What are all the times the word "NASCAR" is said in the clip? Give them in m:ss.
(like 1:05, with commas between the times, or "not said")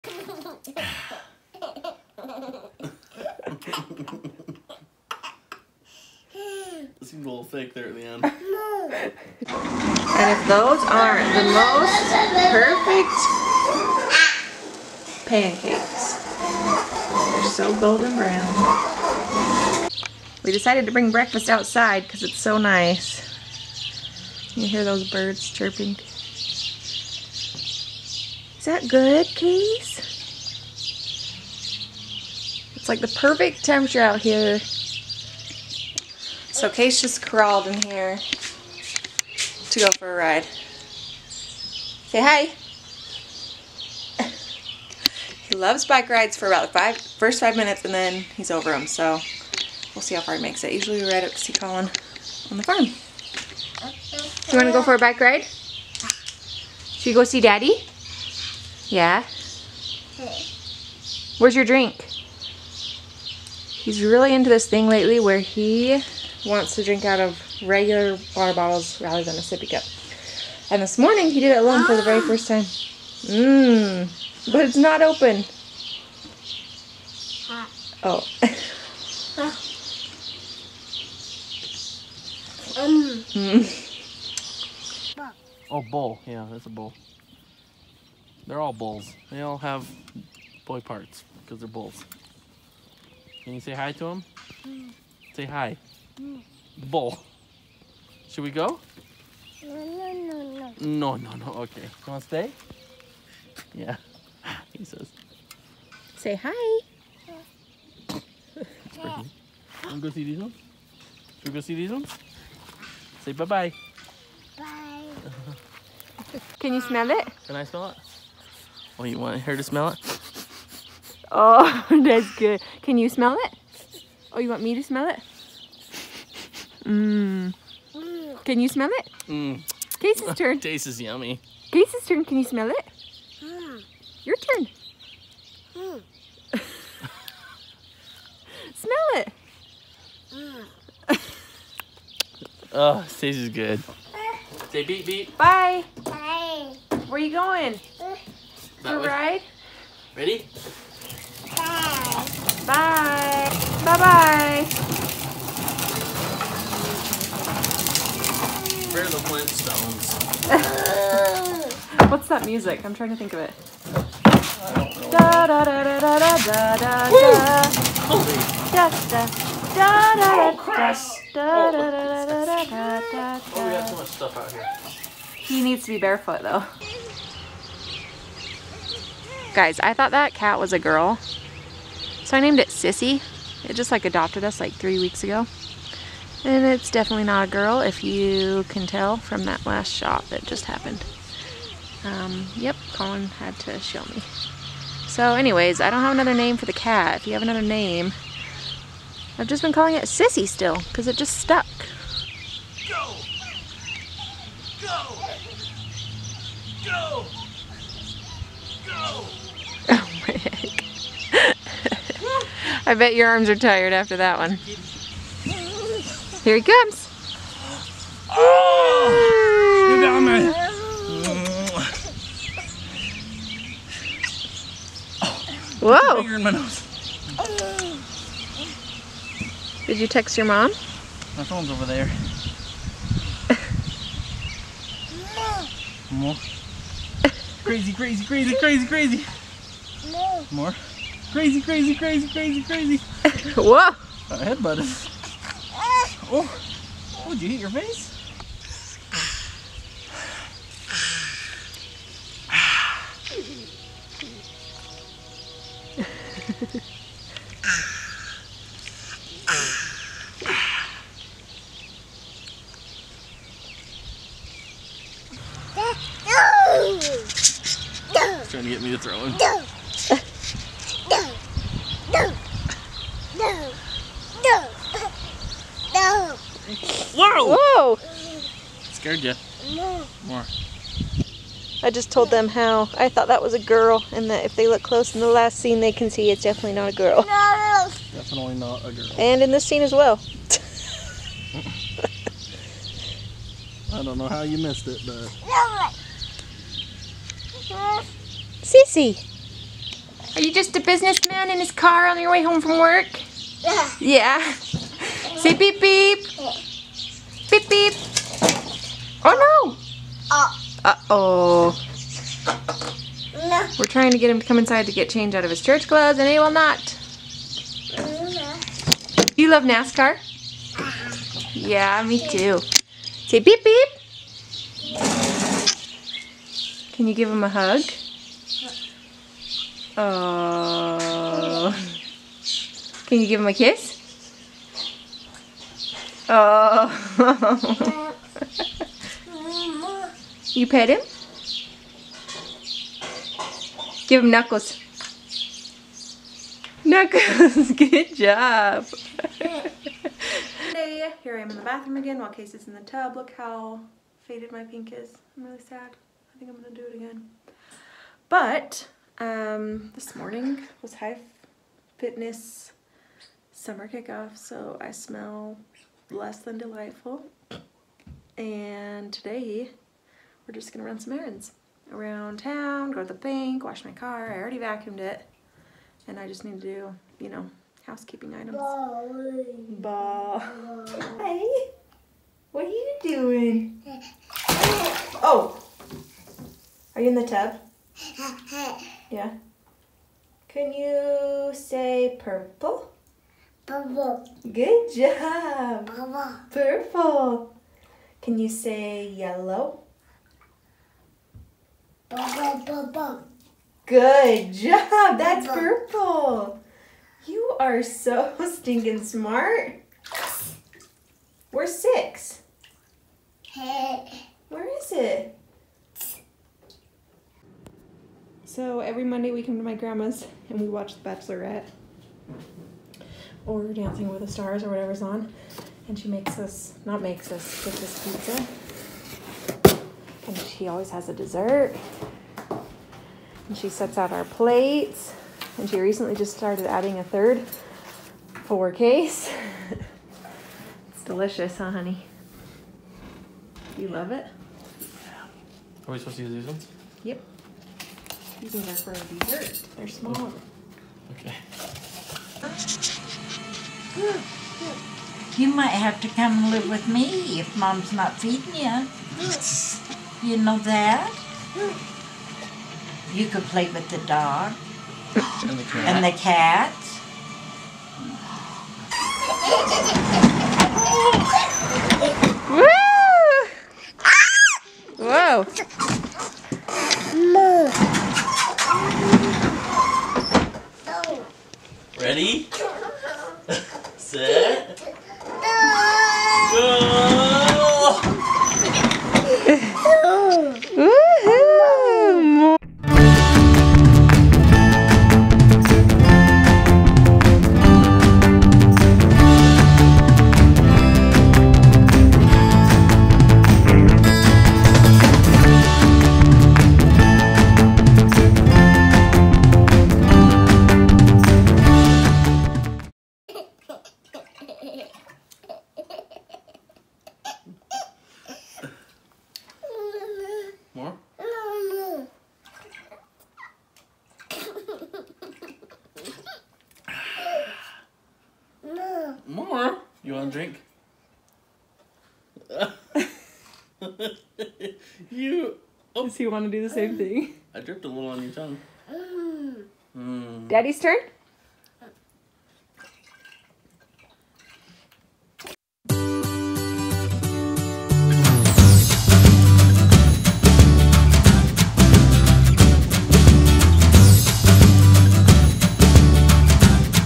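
5:19.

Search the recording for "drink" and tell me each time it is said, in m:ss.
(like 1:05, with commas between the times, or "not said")
1:01, 1:06, 8:50.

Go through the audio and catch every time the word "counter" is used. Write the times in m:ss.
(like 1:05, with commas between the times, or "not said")
not said.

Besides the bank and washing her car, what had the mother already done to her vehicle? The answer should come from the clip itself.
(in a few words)
vacuumed it.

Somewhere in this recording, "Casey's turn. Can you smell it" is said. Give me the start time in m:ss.
2:11.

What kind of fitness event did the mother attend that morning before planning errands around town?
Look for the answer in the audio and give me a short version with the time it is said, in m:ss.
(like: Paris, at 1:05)
high fitness summer kickoff, at 6:00.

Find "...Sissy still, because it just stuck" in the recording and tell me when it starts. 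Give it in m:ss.
3:20.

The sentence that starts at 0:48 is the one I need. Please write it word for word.
So we'll see how far he makes it.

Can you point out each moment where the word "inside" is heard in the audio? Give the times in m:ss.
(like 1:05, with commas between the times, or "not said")
5:14.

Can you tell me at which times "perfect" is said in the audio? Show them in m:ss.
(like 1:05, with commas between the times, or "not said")
0:12, 0:33.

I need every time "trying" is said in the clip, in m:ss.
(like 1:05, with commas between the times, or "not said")
2:42, 4:28, 5:13.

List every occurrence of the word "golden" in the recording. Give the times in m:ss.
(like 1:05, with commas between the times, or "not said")
0:17.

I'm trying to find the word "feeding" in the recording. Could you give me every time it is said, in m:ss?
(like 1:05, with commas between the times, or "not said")
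7:38.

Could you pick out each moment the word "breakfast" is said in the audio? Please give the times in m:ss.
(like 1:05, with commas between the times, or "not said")
0:21.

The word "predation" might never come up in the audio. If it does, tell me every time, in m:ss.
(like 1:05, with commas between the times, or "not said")
not said.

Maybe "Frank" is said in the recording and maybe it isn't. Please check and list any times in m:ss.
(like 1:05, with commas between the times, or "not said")
not said.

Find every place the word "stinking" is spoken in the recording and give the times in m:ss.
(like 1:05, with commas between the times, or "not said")
6:48.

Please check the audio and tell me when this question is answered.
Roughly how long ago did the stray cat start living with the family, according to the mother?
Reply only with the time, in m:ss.
3:04.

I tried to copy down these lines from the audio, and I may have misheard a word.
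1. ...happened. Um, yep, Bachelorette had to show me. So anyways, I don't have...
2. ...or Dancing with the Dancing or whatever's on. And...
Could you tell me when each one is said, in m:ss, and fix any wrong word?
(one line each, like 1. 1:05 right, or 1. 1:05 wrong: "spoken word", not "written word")
1. 3:10 wrong: "Colin", not "Bachelorette"
2. 7:03 wrong: "Stars", not "Dancing".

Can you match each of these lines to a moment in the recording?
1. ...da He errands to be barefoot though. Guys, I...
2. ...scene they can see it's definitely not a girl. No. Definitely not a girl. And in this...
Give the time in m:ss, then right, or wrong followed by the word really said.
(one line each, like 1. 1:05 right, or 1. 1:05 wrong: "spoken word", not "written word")
1. 2:54 wrong: "needs", not "errands"
2. 4:45 right.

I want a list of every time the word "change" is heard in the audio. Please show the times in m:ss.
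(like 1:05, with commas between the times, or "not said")
5:15.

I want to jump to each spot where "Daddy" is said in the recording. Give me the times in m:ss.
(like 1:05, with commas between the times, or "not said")
0:57, 9:00.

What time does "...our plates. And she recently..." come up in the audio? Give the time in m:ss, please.
7:14.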